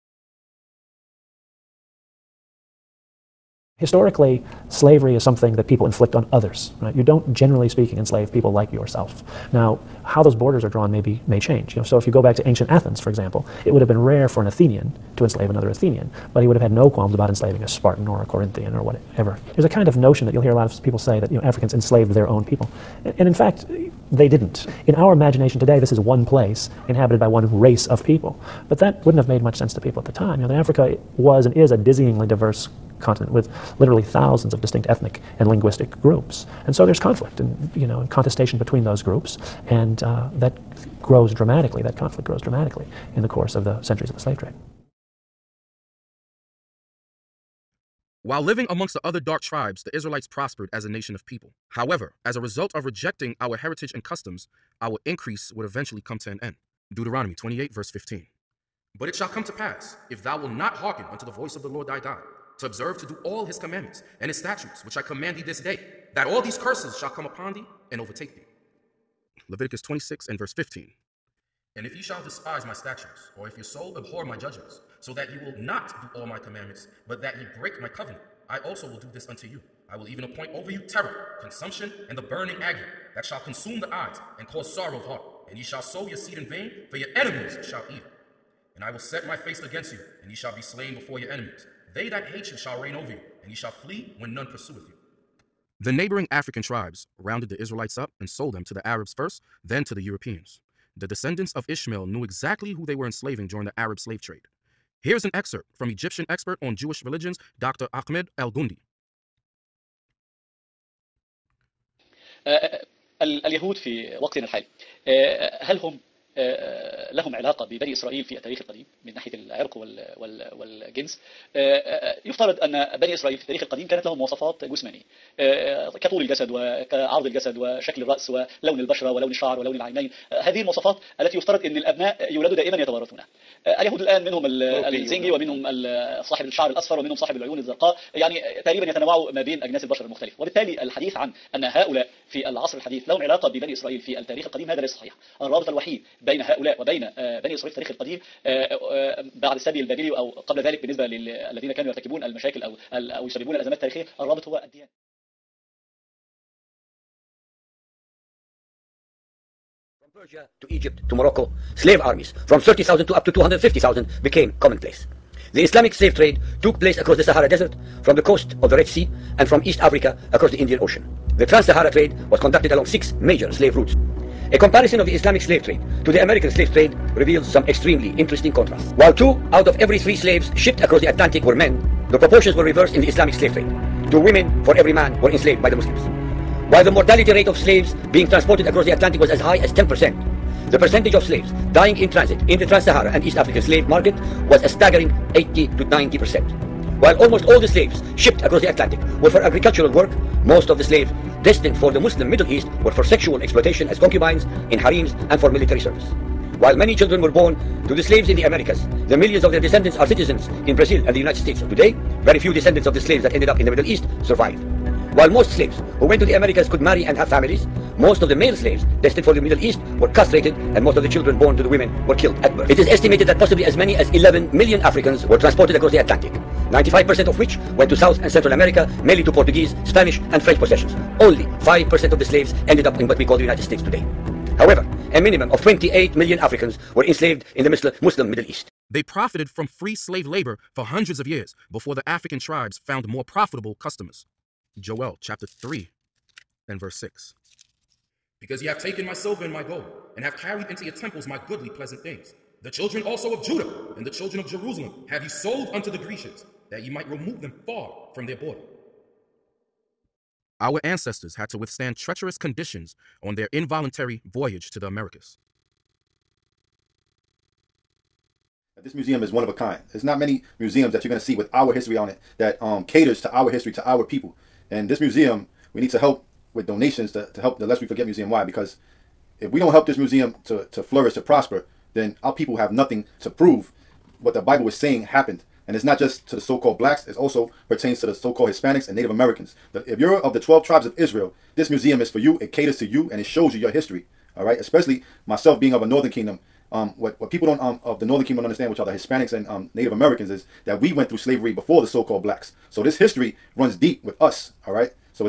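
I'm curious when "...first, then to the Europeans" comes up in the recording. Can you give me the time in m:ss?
1:39.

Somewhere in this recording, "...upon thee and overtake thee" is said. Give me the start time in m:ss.
1:07.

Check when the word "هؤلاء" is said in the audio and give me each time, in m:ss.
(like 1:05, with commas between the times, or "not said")
2:21, 2:26.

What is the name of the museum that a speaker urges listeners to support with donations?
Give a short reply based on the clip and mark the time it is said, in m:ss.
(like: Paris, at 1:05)
Lest We Forget Museum, at 4:37.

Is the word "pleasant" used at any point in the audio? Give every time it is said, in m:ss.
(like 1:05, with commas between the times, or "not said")
4:11.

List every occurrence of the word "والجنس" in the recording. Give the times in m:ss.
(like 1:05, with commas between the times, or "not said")
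2:00.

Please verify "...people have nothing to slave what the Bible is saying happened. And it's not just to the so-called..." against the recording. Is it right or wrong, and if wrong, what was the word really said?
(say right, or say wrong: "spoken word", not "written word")
wrong: "prove", not "slave".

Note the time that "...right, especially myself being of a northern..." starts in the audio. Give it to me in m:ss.
4:54.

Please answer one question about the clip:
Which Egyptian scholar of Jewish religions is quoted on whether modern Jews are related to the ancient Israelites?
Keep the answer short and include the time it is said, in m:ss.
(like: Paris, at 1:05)
Dr. Ahmed El Gundi, at 1:47.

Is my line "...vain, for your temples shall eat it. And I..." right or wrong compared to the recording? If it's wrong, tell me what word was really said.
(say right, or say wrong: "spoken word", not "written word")
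wrong: "enemies", not "temples".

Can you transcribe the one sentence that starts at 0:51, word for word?
However, as a result of rejecting our heritage and customs, our increase would eventually come to an end.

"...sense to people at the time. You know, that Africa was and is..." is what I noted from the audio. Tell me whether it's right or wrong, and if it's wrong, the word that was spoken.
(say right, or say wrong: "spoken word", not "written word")
right.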